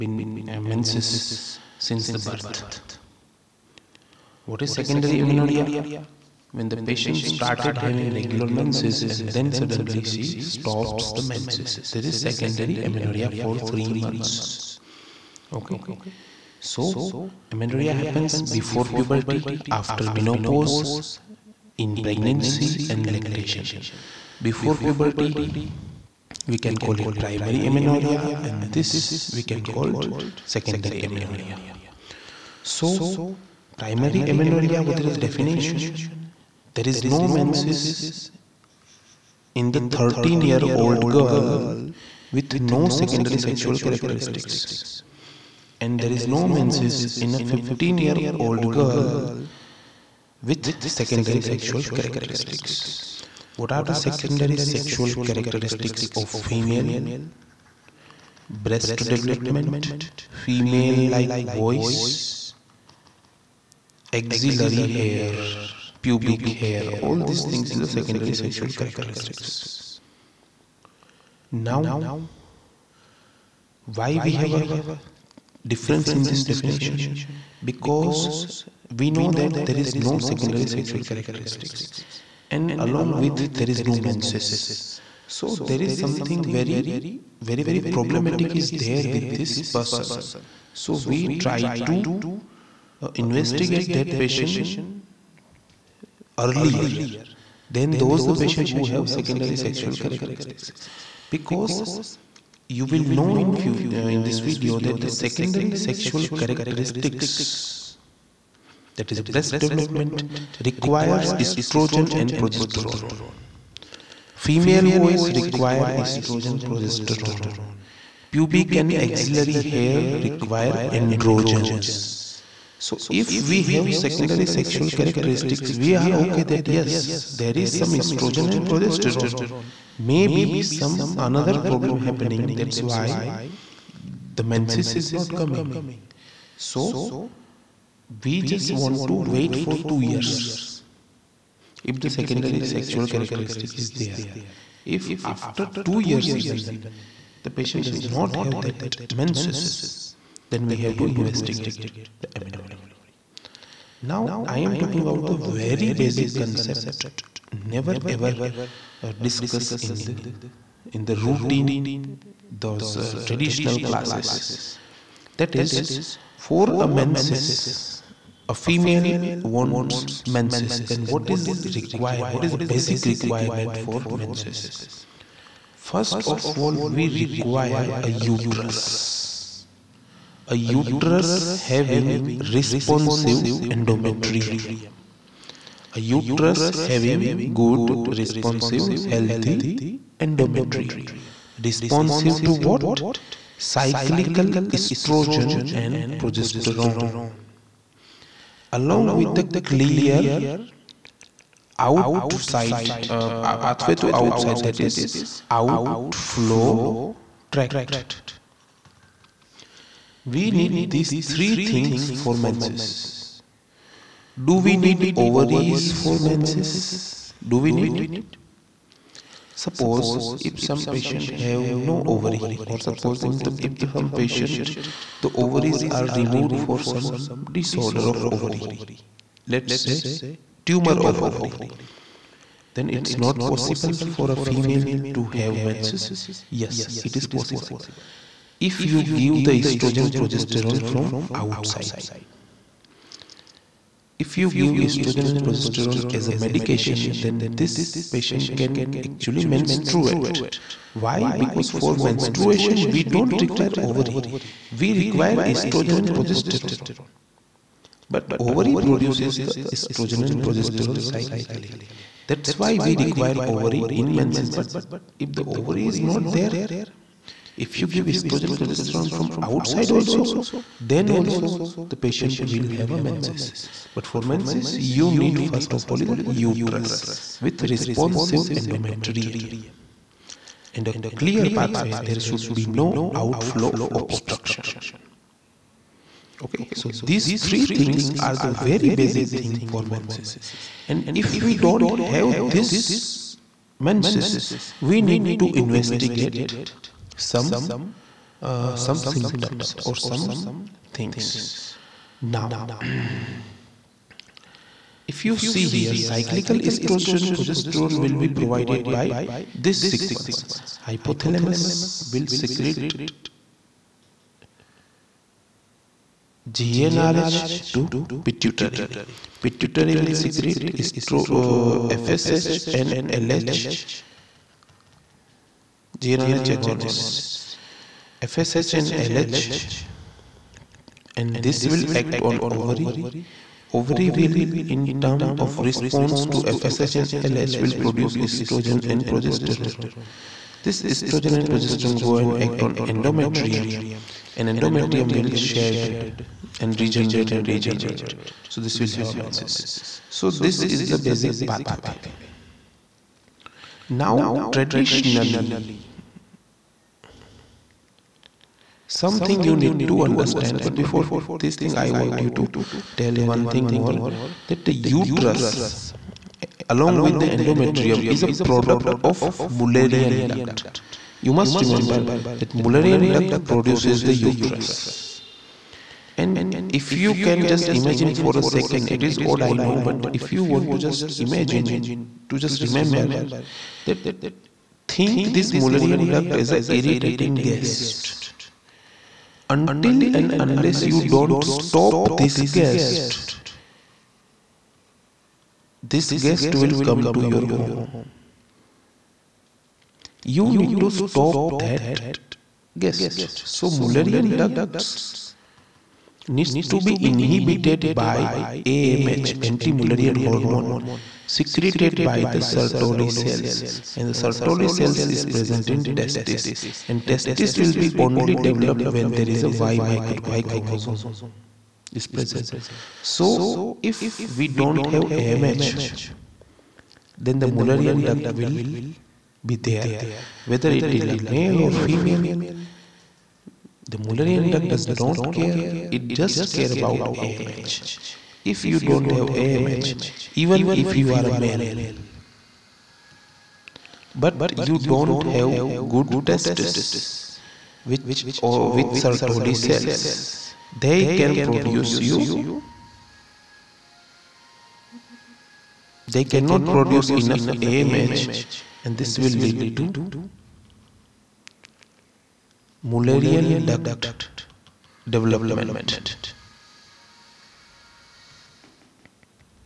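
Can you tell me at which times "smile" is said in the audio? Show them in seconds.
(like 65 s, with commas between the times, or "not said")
not said.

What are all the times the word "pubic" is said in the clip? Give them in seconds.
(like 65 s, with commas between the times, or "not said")
66 s, 118 s.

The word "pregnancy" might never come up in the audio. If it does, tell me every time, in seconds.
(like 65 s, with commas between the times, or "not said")
22 s.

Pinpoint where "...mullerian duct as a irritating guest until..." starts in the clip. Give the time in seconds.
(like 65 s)
385 s.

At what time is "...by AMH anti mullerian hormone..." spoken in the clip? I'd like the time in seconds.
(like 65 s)
408 s.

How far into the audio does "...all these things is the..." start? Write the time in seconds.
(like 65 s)
67 s.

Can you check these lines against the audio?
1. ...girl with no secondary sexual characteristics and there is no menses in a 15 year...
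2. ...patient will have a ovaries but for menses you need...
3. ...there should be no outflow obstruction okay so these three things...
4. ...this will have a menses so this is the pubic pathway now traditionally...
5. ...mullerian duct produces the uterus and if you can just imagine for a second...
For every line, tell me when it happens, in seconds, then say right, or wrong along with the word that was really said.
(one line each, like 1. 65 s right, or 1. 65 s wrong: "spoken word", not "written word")
1. 41 s right
2. 271 s wrong: "menses", not "ovaries"
3. 281 s right
4. 348 s wrong: "basic", not "pubic"
5. 372 s right.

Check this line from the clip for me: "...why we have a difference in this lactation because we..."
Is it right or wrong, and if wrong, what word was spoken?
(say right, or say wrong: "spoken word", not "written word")
wrong: "definition", not "lactation".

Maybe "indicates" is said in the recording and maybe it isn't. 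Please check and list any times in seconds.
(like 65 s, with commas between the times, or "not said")
not said.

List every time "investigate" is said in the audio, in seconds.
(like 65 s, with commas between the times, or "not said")
93 s, 151 s, 295 s.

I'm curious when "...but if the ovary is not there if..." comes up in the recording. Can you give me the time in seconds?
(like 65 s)
264 s.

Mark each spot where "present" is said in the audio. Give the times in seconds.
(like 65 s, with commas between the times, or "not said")
415 s, 422 s.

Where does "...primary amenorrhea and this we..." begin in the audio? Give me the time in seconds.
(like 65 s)
27 s.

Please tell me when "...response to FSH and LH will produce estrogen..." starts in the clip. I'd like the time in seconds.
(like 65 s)
335 s.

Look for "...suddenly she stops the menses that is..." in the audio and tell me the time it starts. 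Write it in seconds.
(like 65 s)
9 s.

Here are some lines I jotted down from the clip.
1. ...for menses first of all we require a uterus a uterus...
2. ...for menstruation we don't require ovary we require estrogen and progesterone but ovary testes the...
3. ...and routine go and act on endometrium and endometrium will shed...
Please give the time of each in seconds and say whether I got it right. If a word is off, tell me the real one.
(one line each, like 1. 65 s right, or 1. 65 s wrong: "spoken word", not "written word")
1. 173 s right
2. 251 s wrong: "produces", not "testes"
3. 341 s wrong: "progesterone", not "routine".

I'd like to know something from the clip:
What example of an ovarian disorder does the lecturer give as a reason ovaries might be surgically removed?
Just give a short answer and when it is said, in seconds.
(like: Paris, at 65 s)
Tumor of ovary, at 230 s.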